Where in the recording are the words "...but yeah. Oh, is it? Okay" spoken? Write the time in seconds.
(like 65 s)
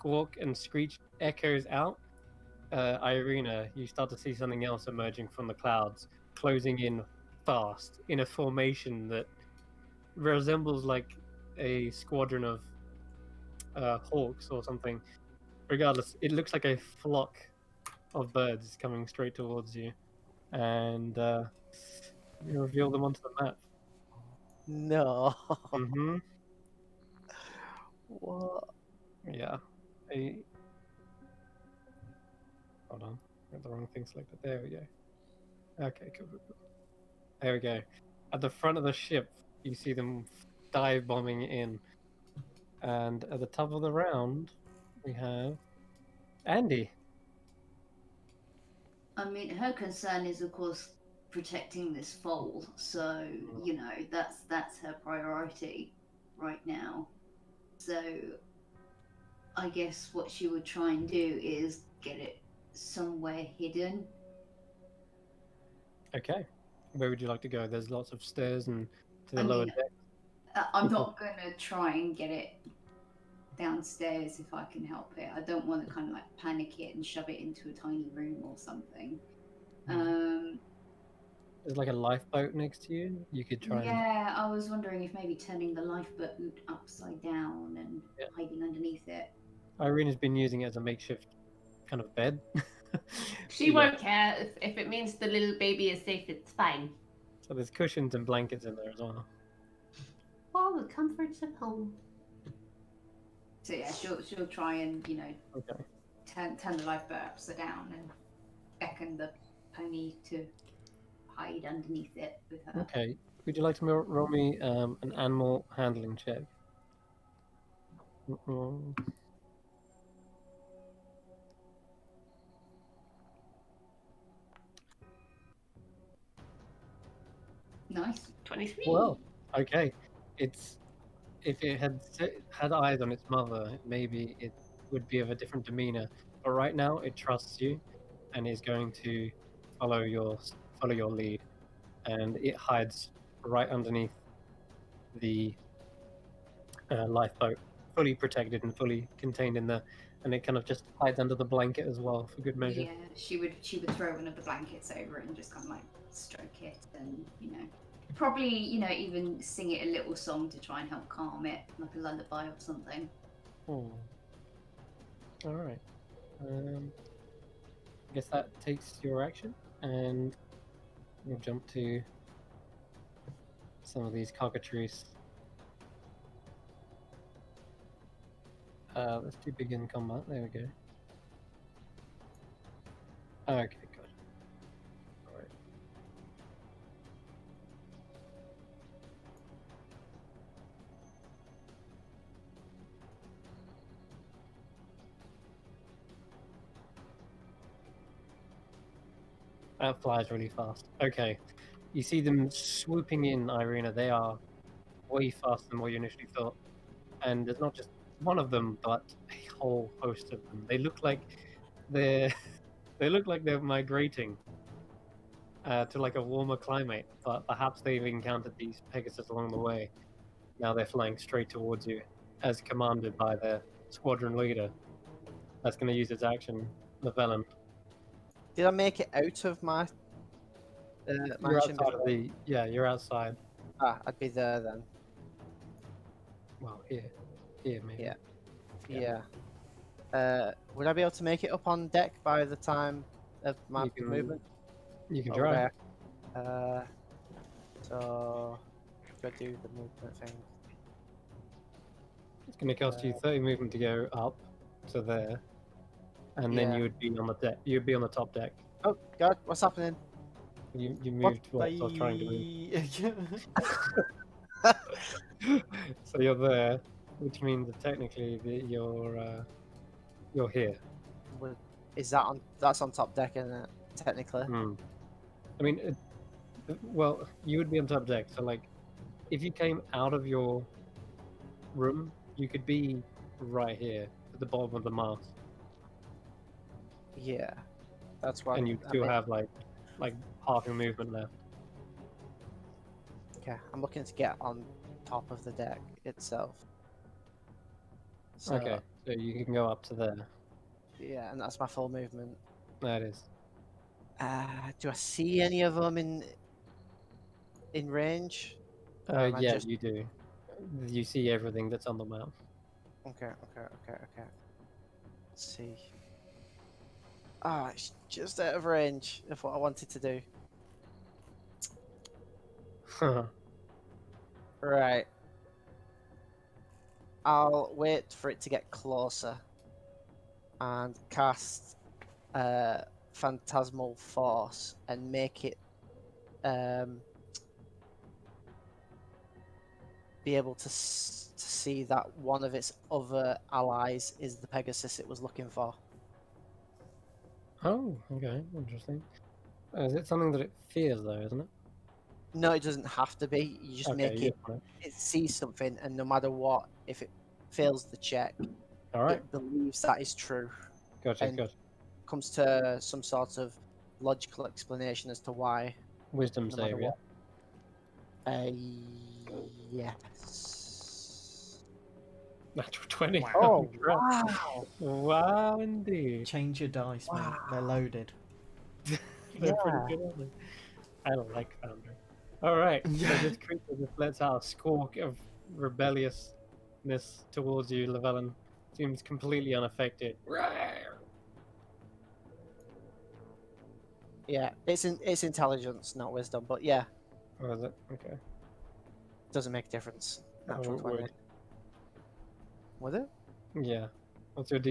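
396 s.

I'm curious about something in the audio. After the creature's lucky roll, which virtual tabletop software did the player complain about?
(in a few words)
Foundry.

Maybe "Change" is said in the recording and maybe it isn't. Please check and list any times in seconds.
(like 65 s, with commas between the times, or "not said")
376 s.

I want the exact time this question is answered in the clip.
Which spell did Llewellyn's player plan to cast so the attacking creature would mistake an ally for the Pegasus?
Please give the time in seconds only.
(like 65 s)
333 s.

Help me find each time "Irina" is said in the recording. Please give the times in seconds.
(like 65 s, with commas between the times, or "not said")
3 s, 89 s, 203 s.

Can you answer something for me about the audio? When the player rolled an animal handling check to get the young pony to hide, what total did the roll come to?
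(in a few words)
23.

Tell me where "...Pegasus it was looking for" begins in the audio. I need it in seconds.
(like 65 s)
344 s.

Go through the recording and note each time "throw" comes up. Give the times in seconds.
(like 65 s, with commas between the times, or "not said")
153 s.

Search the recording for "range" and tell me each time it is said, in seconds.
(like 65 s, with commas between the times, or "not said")
307 s, 318 s.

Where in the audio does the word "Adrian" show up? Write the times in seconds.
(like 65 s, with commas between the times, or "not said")
not said.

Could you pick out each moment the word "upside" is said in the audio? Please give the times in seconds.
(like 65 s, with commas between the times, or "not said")
86 s, 107 s.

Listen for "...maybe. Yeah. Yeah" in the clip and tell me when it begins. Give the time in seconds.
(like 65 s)
237 s.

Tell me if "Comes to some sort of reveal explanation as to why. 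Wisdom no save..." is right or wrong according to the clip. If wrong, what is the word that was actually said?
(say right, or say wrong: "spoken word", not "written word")
wrong: "logical", not "reveal".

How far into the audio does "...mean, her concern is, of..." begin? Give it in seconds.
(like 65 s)
49 s.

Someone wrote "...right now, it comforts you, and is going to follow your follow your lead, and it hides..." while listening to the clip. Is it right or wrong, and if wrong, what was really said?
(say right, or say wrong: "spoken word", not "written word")
wrong: "trusts", not "comforts".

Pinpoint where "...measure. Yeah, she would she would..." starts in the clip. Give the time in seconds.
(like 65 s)
152 s.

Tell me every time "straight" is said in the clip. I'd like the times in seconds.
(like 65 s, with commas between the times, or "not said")
19 s, 221 s.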